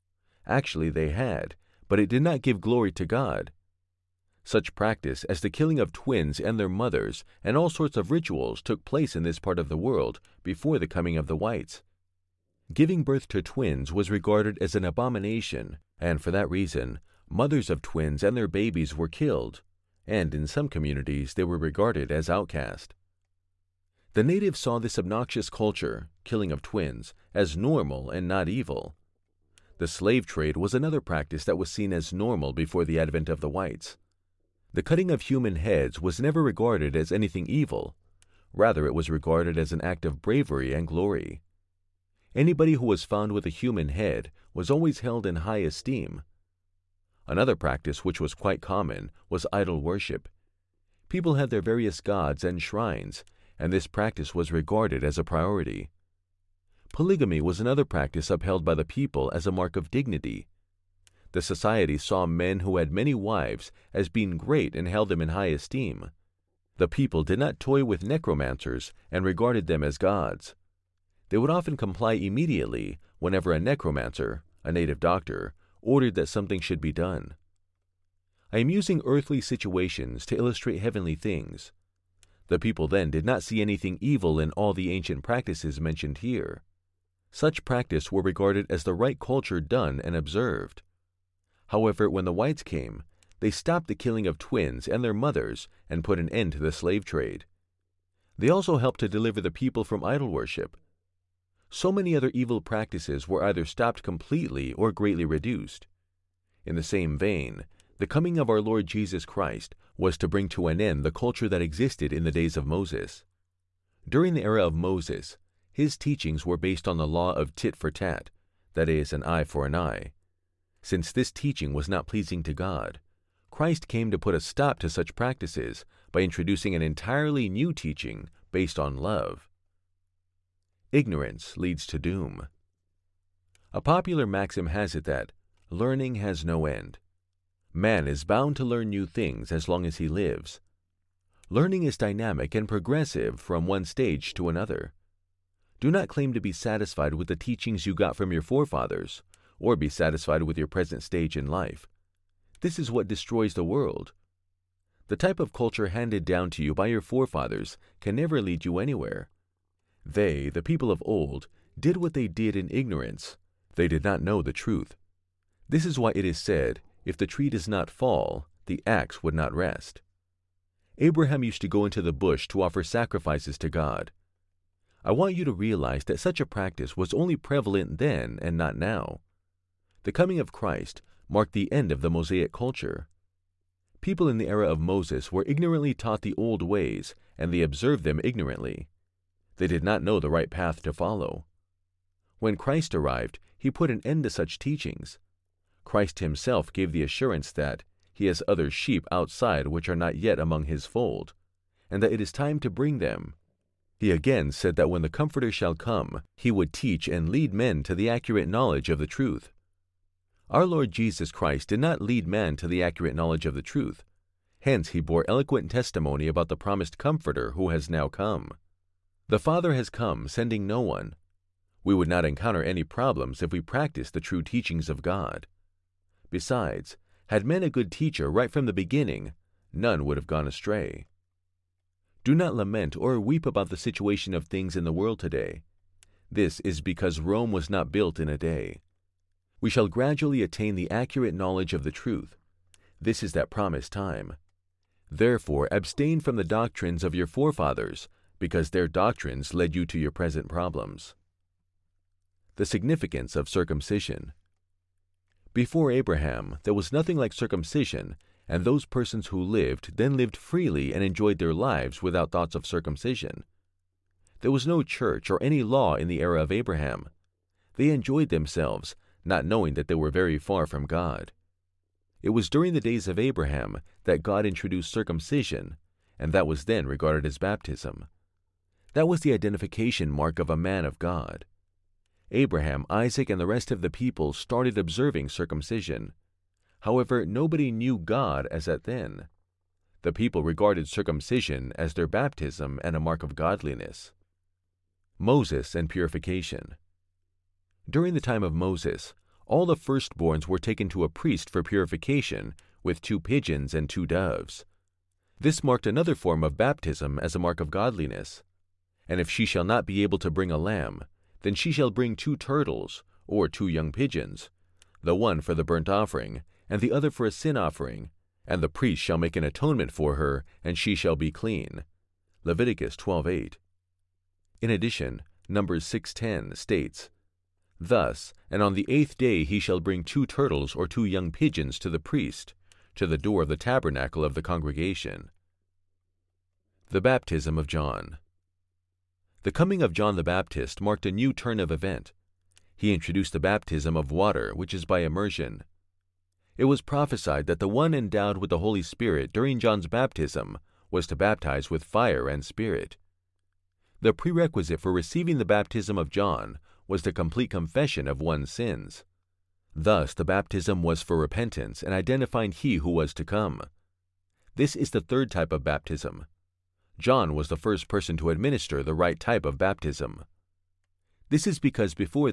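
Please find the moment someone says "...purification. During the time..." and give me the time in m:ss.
4:55.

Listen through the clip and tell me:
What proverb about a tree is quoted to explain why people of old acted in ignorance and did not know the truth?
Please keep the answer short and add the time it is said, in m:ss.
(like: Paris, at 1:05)
If the tree does not fall, the axe would not rest, at 2:47.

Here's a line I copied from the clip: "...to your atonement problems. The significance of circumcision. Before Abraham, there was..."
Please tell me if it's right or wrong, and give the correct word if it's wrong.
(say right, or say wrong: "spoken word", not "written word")
wrong: "present", not "atonement".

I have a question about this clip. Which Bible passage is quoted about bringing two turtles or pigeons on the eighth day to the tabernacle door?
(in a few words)
Numbers 6:10.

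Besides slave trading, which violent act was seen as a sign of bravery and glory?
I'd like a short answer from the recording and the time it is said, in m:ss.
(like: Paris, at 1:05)
Cutting of human heads, at 0:34.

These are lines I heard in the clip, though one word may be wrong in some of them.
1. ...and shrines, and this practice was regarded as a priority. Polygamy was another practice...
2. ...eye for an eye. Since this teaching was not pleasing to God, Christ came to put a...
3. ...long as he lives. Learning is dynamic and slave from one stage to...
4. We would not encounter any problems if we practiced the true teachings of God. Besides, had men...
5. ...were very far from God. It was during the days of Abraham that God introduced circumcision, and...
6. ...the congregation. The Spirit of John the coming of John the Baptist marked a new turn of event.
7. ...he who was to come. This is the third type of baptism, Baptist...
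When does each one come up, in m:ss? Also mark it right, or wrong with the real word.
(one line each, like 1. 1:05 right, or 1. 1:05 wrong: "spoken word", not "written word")
1. 0:52 right
2. 1:59 right
3. 2:19 wrong: "progressive", not "slave"
4. 3:41 right
5. 4:29 right
6. 5:34 wrong: "Baptism", not "Spirit"
7. 6:02 wrong: "John", not "Baptist".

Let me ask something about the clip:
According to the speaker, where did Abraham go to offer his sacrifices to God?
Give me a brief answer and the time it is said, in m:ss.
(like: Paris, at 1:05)
The bush, at 2:52.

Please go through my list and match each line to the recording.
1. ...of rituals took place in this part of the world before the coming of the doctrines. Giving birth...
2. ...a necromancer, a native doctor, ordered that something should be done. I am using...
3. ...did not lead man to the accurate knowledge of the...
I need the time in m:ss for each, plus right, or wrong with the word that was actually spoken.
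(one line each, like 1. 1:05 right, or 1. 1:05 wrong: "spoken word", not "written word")
1. 0:07 wrong: "whites", not "doctrines"
2. 1:13 right
3. 3:31 right.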